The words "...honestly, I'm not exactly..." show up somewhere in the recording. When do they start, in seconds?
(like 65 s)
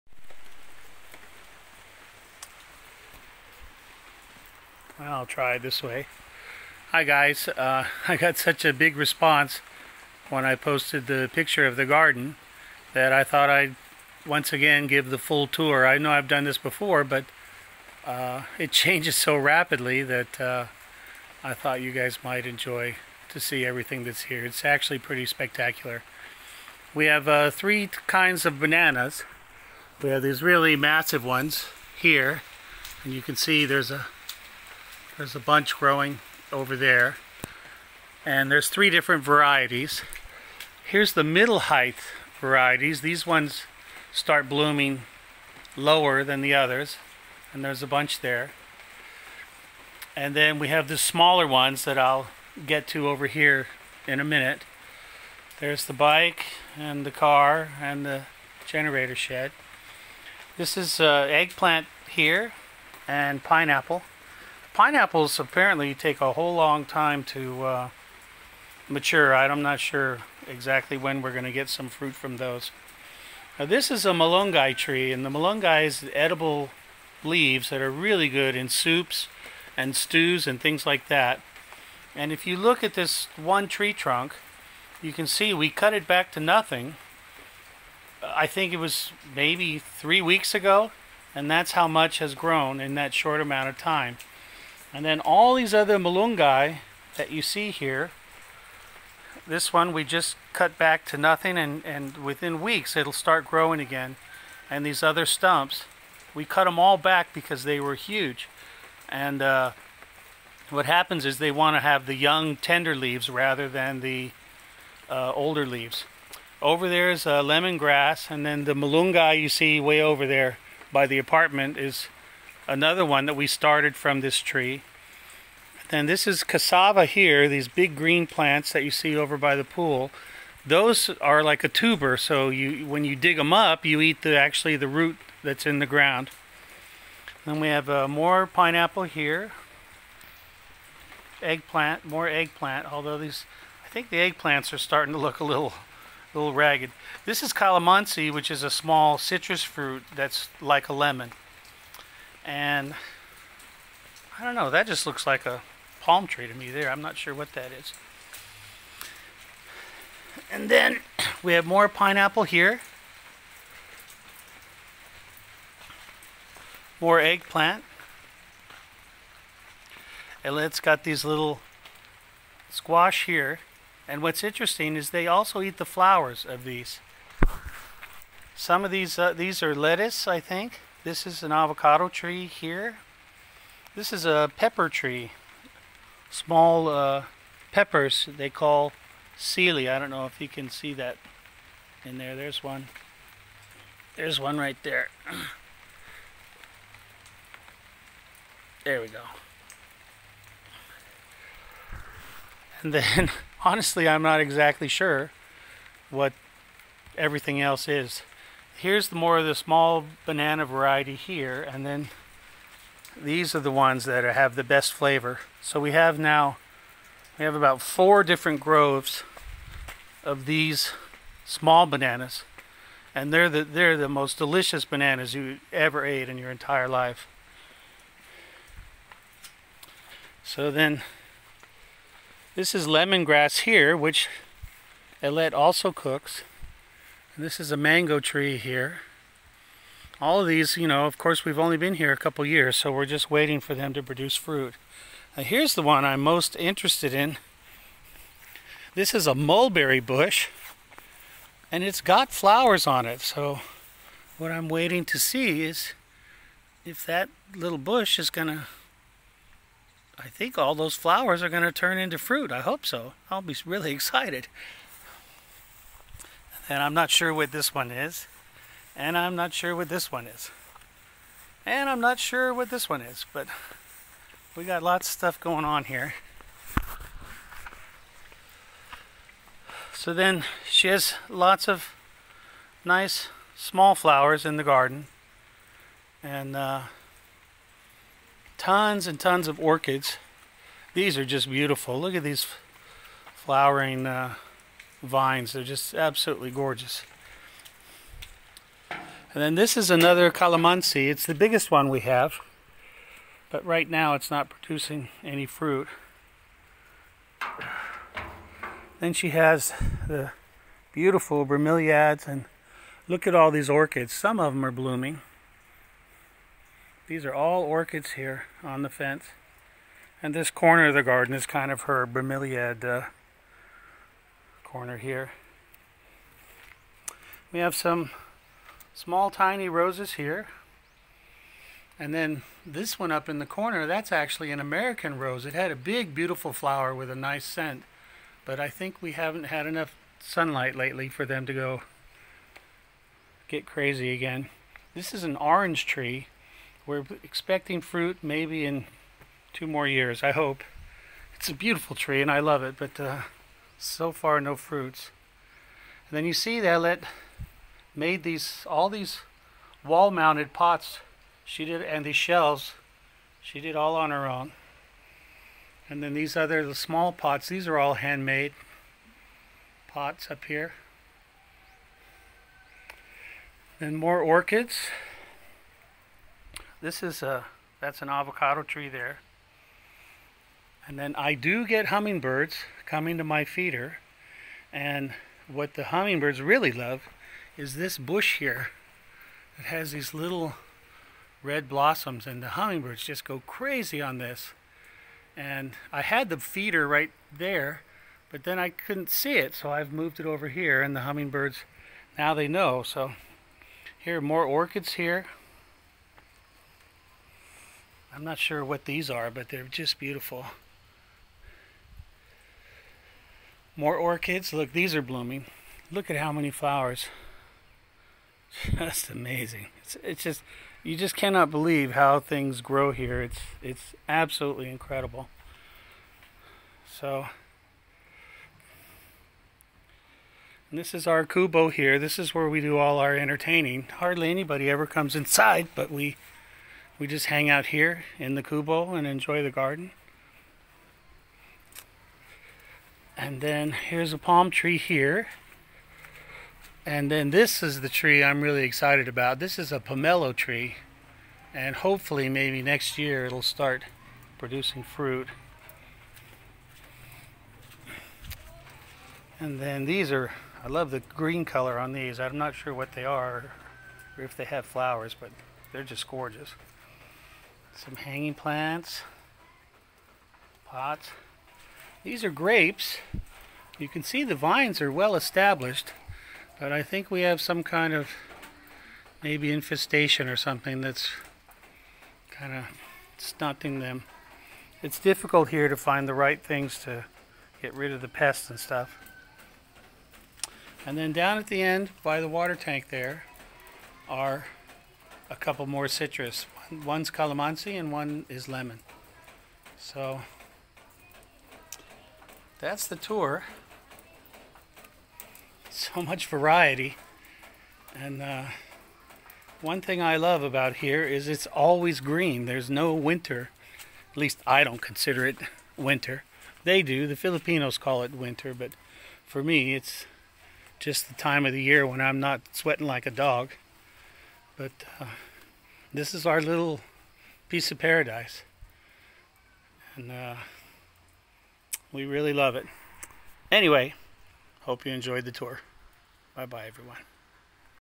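203 s.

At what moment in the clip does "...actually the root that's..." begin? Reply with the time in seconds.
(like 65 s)
134 s.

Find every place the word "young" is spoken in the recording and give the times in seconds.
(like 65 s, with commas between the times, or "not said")
112 s.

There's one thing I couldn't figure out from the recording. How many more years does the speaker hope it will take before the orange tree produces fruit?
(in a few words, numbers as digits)
2 years.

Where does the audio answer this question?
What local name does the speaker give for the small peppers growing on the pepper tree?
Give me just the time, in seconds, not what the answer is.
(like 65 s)
189 s.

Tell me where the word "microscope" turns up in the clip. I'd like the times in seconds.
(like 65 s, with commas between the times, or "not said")
not said.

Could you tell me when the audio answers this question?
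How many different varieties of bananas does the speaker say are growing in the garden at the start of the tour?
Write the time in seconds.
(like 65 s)
27 s.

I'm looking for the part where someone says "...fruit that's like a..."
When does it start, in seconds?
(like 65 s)
149 s.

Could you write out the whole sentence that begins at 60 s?
This is uh, eggplant here and pineapple.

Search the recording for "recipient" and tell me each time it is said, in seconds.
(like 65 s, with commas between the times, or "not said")
not said.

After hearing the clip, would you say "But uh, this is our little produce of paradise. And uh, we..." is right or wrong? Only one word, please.
wrong.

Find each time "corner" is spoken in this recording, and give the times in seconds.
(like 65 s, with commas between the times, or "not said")
320 s, 324 s, 333 s.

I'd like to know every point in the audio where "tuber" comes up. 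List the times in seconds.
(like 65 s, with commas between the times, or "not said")
131 s.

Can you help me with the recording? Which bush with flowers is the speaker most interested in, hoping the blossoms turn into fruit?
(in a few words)
Mulberry bush.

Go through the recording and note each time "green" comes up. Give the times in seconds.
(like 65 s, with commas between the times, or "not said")
127 s, 461 s, 511 s.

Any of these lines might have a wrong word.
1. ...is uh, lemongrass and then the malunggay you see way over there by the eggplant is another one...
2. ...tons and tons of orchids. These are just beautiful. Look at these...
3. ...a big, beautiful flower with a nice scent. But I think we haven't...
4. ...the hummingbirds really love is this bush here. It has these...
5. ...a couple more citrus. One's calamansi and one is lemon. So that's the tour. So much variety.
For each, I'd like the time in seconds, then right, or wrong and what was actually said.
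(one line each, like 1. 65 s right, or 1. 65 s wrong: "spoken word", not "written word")
1. 117 s wrong: "apartment", not "eggplant"
2. 288 s right
3. 335 s right
4. 385 s right
5. 495 s right.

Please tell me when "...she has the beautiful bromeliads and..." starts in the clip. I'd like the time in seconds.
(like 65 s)
309 s.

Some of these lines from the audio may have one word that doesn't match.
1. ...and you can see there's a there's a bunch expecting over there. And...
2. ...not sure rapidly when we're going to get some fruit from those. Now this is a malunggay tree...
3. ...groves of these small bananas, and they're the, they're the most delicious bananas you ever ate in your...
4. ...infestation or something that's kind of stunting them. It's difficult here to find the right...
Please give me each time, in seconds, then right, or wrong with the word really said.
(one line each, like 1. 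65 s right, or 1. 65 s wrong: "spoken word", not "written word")
1. 33 s wrong: "growing", not "expecting"
2. 69 s wrong: "exactly", not "rapidly"
3. 218 s right
4. 479 s right.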